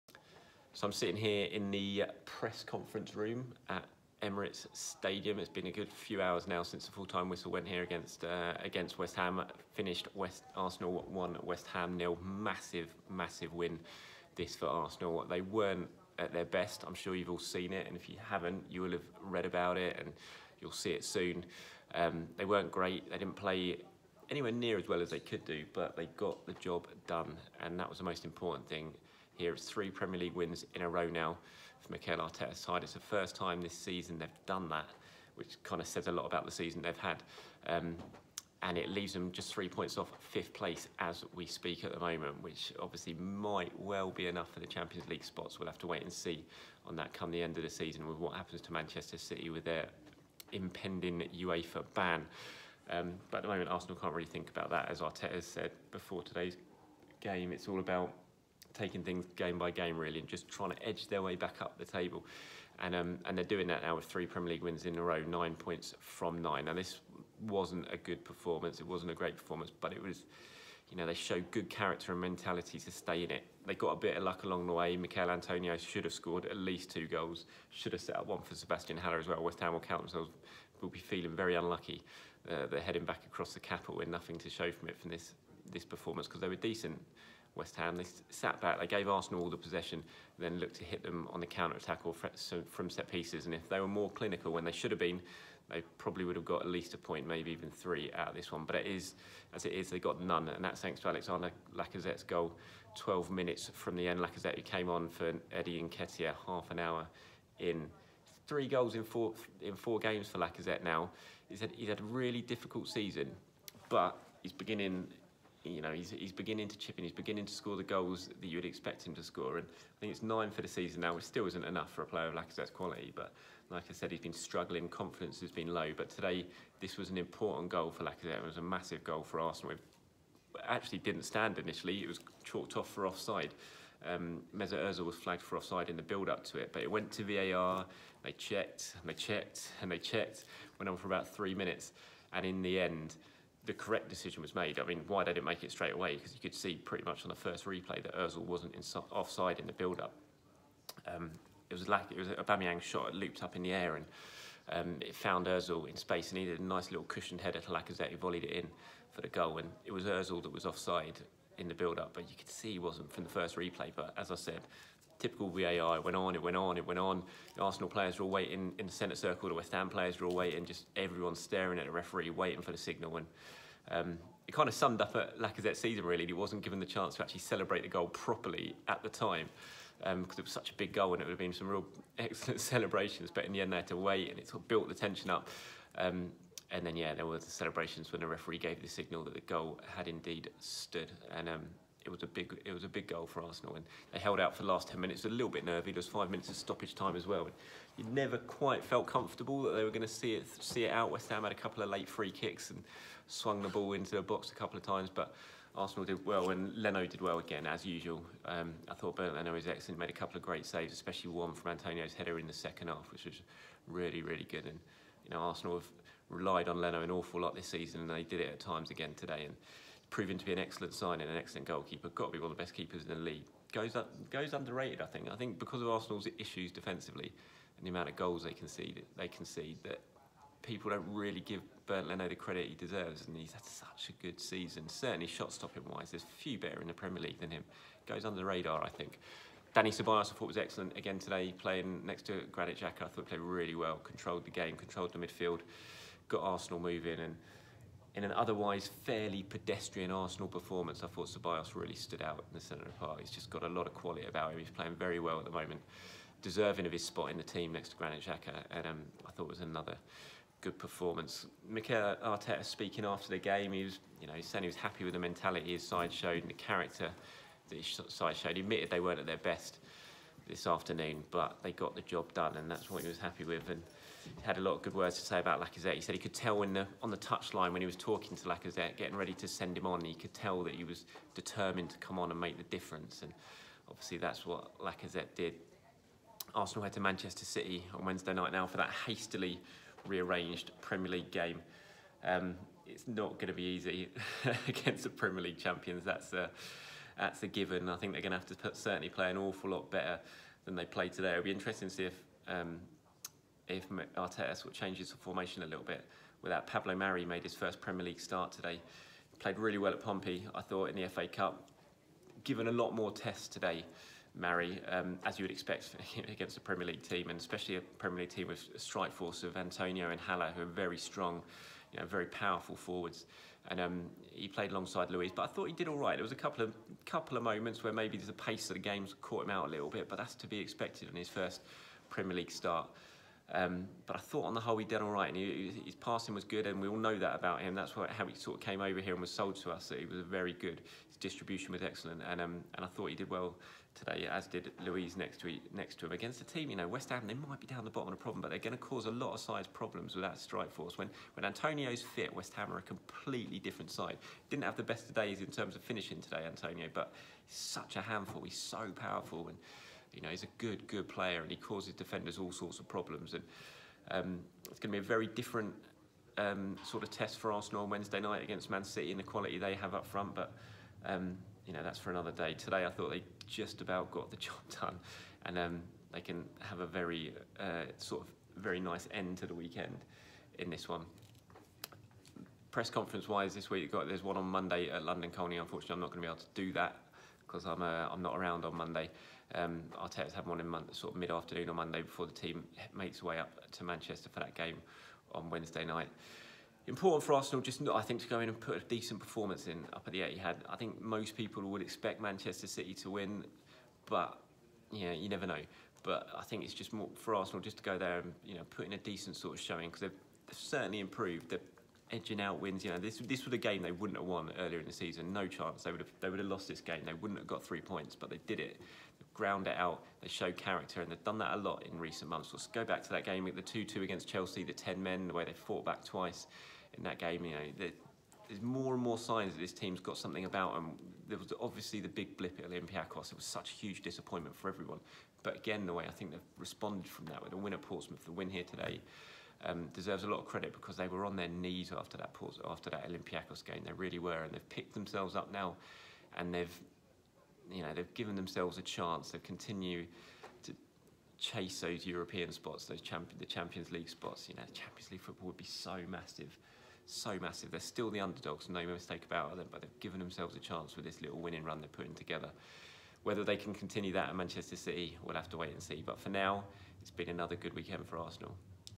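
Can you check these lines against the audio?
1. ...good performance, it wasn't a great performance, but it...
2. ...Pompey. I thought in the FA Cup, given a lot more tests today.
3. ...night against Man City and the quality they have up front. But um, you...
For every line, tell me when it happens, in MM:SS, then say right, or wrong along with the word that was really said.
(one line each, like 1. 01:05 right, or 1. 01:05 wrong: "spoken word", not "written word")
1. 01:07 right
2. 05:10 right
3. 06:08 right.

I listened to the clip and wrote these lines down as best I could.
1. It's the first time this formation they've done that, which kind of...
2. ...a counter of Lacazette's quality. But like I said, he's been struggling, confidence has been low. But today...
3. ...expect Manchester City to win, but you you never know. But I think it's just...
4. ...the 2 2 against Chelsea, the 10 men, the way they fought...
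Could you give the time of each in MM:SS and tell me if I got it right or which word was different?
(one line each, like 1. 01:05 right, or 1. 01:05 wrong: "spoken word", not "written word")
1. 00:32 wrong: "season", not "formation"
2. 02:02 wrong: "player", not "counter"
3. 06:41 right
4. 07:03 right.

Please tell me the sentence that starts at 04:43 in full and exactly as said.
And obviously that's what Lacazette did.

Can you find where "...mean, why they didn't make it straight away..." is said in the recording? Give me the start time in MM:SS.
02:24.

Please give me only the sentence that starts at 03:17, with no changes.
you never quite felt comfortable that they were going to see it see it out.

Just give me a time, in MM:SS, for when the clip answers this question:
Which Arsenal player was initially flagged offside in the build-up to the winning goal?
02:14.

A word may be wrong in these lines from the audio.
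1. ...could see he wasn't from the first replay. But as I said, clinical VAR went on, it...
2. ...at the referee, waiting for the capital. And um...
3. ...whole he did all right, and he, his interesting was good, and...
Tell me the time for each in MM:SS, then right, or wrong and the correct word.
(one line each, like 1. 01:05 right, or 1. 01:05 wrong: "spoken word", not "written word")
1. 02:42 wrong: "typical", not "clinical"
2. 02:51 wrong: "signal", not "capital"
3. 05:34 wrong: "passing", not "interesting".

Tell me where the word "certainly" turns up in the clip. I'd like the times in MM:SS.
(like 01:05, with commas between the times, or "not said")
03:54, 04:58, 06:50.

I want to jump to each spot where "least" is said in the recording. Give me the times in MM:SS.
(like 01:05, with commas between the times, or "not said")
01:16, 01:36.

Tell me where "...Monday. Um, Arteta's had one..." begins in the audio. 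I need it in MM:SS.
06:28.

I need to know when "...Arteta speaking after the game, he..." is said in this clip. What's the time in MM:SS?
04:22.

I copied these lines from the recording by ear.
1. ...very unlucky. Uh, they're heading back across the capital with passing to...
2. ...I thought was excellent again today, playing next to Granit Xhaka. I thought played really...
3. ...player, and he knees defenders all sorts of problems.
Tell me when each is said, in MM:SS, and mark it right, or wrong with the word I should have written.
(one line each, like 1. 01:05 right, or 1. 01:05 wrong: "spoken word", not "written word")
1. 01:21 wrong: "nothing", not "passing"
2. 04:00 right
3. 06:01 wrong: "causes", not "knees".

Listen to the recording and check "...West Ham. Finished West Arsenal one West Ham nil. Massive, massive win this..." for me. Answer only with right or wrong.
right.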